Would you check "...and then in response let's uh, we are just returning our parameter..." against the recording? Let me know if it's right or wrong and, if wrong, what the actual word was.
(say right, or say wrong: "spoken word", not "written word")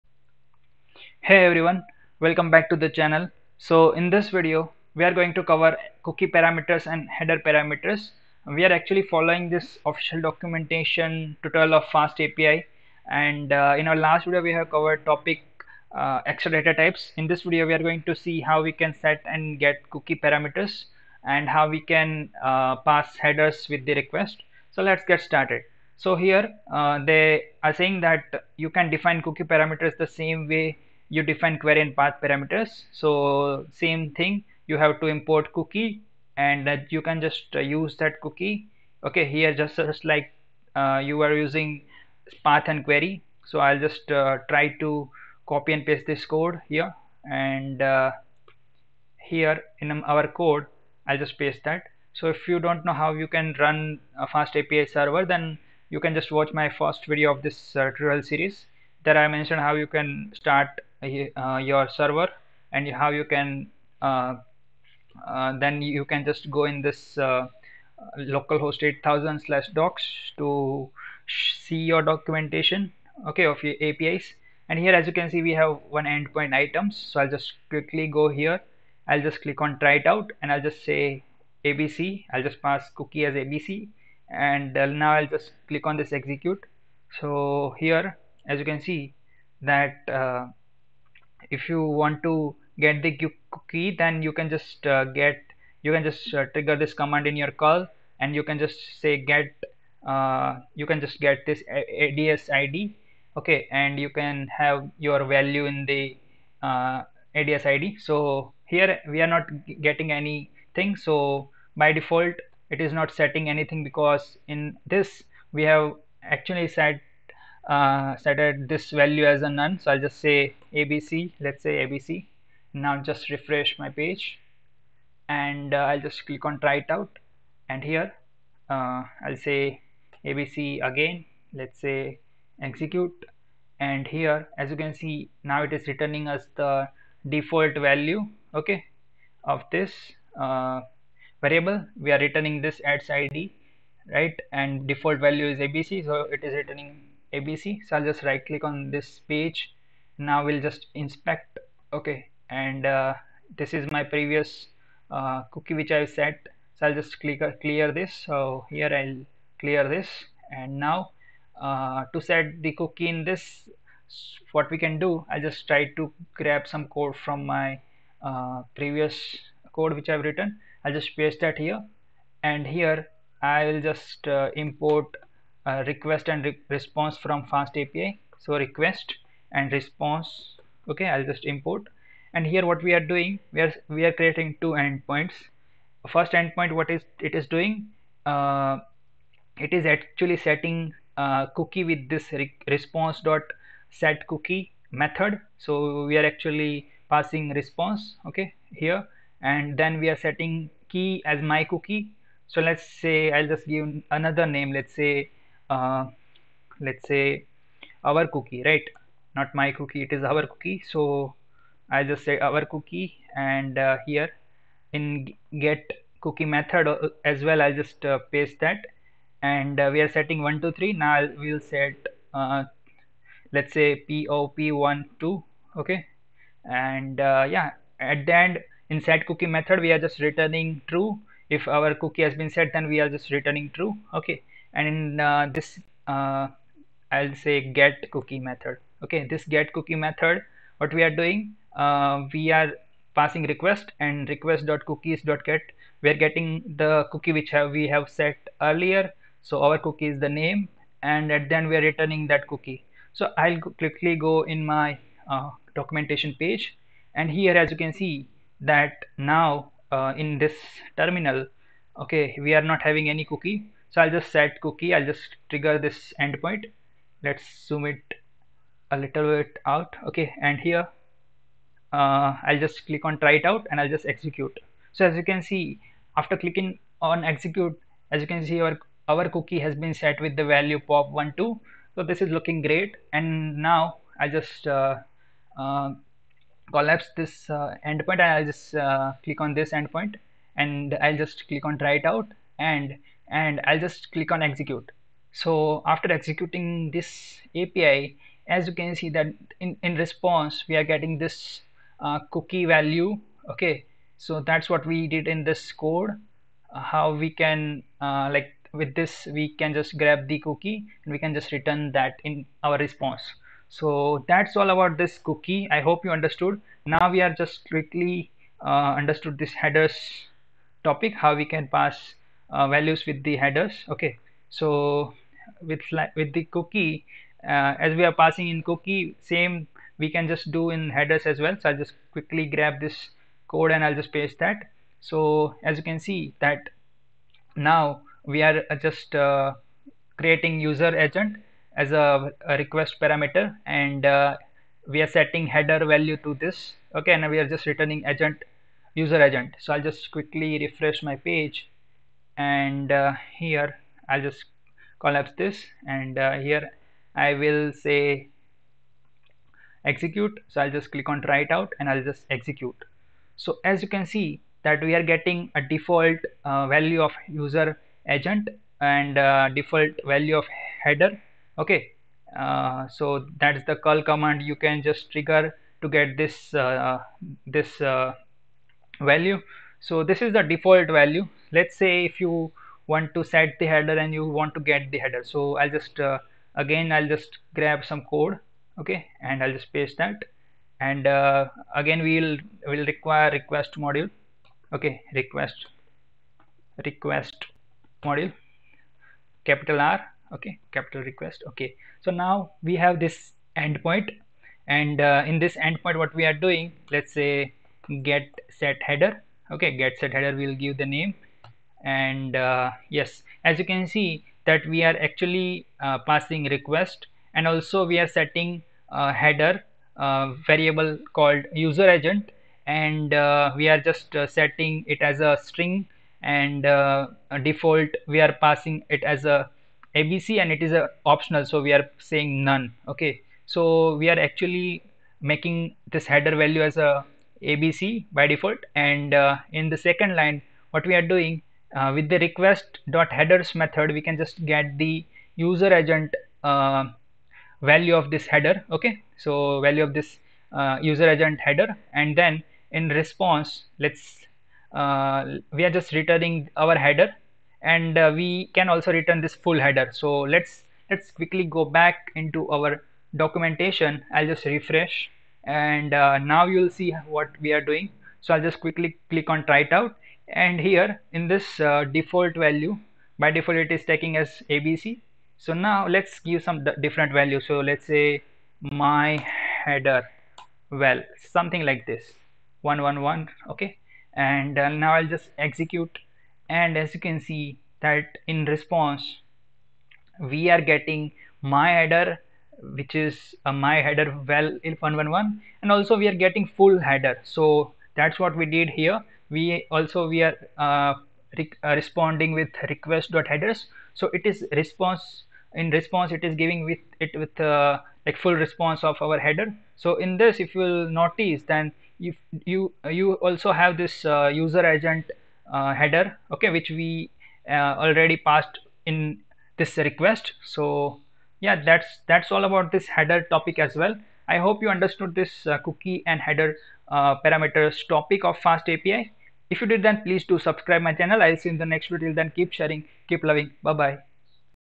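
wrong: "header", not "parameter".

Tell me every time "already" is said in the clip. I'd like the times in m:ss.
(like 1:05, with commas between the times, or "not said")
8:37.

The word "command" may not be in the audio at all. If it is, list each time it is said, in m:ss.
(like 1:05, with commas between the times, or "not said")
1:36, 6:14.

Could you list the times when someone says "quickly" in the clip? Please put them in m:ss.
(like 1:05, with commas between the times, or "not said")
1:17, 4:13, 5:17, 5:32, 5:50, 7:41, 7:48.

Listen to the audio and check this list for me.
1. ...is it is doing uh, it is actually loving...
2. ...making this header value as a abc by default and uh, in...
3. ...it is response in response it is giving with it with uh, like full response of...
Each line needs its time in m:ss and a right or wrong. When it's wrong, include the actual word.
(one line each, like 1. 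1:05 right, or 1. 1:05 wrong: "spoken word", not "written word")
1. 3:06 wrong: "setting", not "loving"
2. 7:15 right
3. 8:24 right.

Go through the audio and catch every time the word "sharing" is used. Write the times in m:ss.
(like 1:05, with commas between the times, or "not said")
8:52.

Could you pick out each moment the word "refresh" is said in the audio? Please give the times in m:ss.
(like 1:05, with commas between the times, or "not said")
2:03, 5:50, 7:44.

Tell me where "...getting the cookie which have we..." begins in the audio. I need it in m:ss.
4:06.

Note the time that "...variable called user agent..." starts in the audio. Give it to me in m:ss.
7:00.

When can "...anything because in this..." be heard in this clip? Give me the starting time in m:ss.
1:53.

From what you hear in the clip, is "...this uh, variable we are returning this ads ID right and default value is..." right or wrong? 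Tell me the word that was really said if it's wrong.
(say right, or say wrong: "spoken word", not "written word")
right.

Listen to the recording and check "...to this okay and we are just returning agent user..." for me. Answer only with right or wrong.
right.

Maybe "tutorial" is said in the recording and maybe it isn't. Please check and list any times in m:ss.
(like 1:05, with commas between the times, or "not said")
0:11, 0:57.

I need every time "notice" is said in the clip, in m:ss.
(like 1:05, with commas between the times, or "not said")
8:30.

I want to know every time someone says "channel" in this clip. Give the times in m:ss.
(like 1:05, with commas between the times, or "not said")
0:02, 8:50.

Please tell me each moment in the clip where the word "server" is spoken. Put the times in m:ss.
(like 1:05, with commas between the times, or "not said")
0:54, 1:01.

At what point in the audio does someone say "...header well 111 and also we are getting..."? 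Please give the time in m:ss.
8:13.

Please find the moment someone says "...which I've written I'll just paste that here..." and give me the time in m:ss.
2:49.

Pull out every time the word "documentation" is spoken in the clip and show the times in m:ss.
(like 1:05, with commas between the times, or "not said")
0:10, 1:12, 4:15, 7:43.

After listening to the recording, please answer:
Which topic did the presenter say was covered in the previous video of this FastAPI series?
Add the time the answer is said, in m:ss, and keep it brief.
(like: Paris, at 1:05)
Extra data types, at 0:16.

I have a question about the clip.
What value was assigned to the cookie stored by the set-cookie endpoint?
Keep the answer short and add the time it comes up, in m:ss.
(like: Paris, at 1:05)
pop12, at 3:44.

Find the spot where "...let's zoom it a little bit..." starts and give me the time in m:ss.
4:27.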